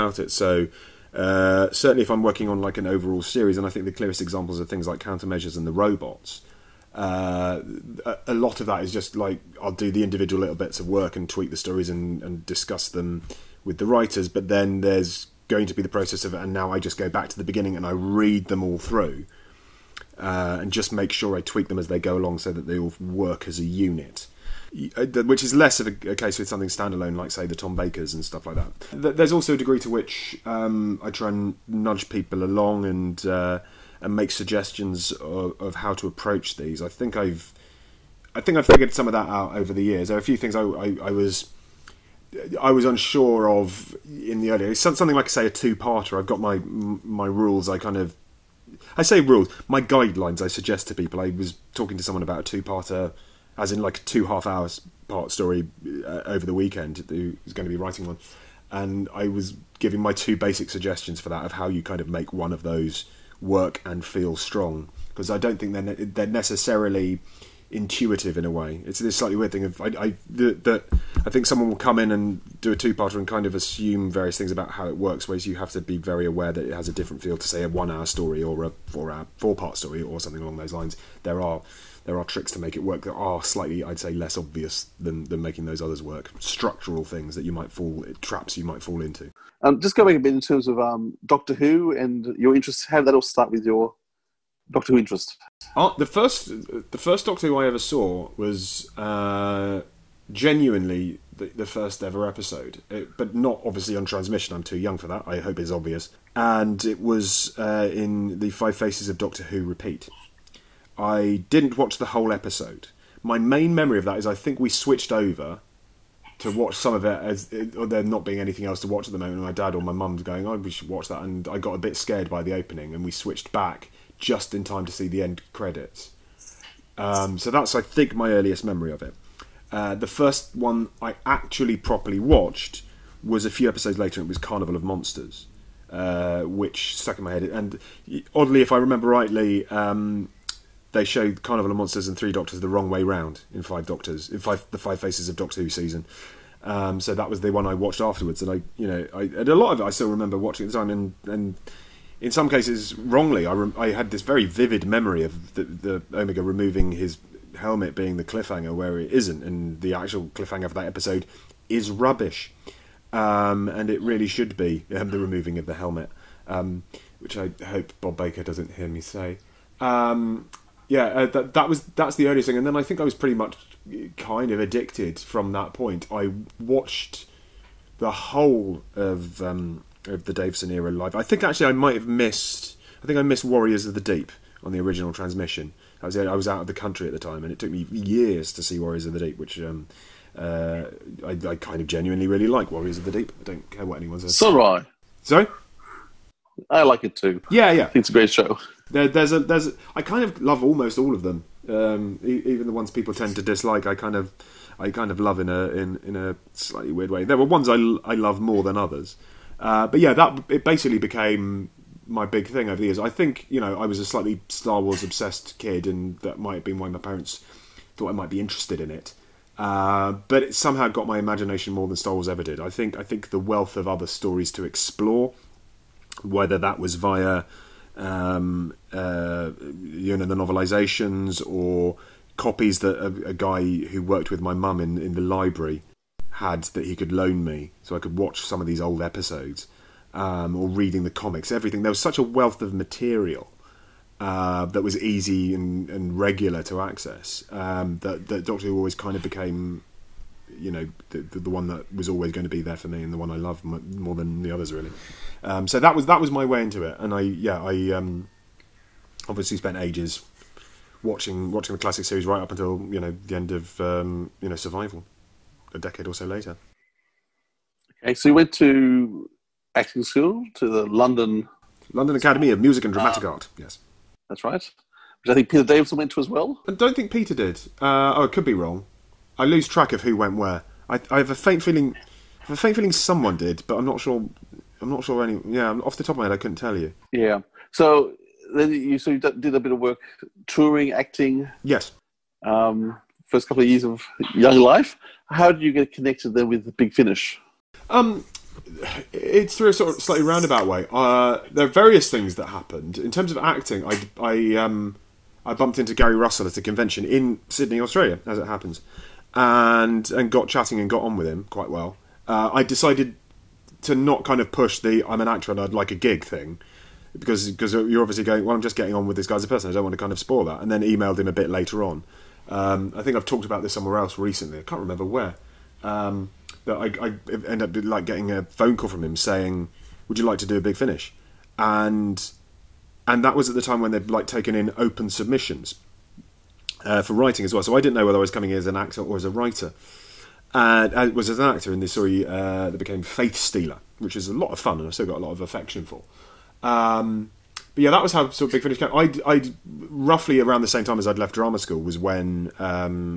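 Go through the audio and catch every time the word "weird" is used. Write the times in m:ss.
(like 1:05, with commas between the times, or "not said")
1:09, 3:26.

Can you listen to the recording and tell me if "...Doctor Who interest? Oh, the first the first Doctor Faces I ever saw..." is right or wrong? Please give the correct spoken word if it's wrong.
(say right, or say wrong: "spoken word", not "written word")
wrong: "Who", not "Faces".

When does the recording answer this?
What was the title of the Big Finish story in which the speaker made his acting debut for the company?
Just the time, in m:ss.
5:43.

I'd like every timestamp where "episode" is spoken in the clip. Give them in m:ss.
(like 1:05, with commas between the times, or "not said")
1:42, 1:52, 2:13, 2:40, 3:59.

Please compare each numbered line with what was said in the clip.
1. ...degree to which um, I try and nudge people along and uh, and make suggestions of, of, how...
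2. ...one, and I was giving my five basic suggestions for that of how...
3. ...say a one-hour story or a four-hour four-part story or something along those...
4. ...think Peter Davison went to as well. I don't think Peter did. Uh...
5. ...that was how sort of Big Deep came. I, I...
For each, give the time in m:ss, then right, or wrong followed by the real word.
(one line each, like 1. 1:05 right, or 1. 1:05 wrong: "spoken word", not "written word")
1. 0:29 right
2. 0:58 wrong: "two", not "five"
3. 1:17 right
4. 4:35 right
5. 5:47 wrong: "Finish", not "Deep".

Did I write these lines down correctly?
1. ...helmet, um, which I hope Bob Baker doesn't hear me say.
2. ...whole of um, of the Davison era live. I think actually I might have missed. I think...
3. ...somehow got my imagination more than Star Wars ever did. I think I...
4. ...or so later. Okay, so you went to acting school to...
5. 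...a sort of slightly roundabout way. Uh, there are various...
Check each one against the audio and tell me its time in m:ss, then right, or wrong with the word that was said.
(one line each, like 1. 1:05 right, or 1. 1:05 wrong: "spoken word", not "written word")
1. 2:45 right
2. 2:58 right
3. 3:40 right
4. 4:26 right
5. 4:59 right.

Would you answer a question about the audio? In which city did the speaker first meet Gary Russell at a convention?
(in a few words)
Sydney.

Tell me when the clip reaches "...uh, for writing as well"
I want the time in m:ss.
5:36.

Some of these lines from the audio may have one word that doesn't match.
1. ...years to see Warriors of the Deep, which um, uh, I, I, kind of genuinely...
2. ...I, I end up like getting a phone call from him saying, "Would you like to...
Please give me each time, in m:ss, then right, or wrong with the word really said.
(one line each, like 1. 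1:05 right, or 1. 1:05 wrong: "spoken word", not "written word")
1. 3:07 right
2. 5:26 right.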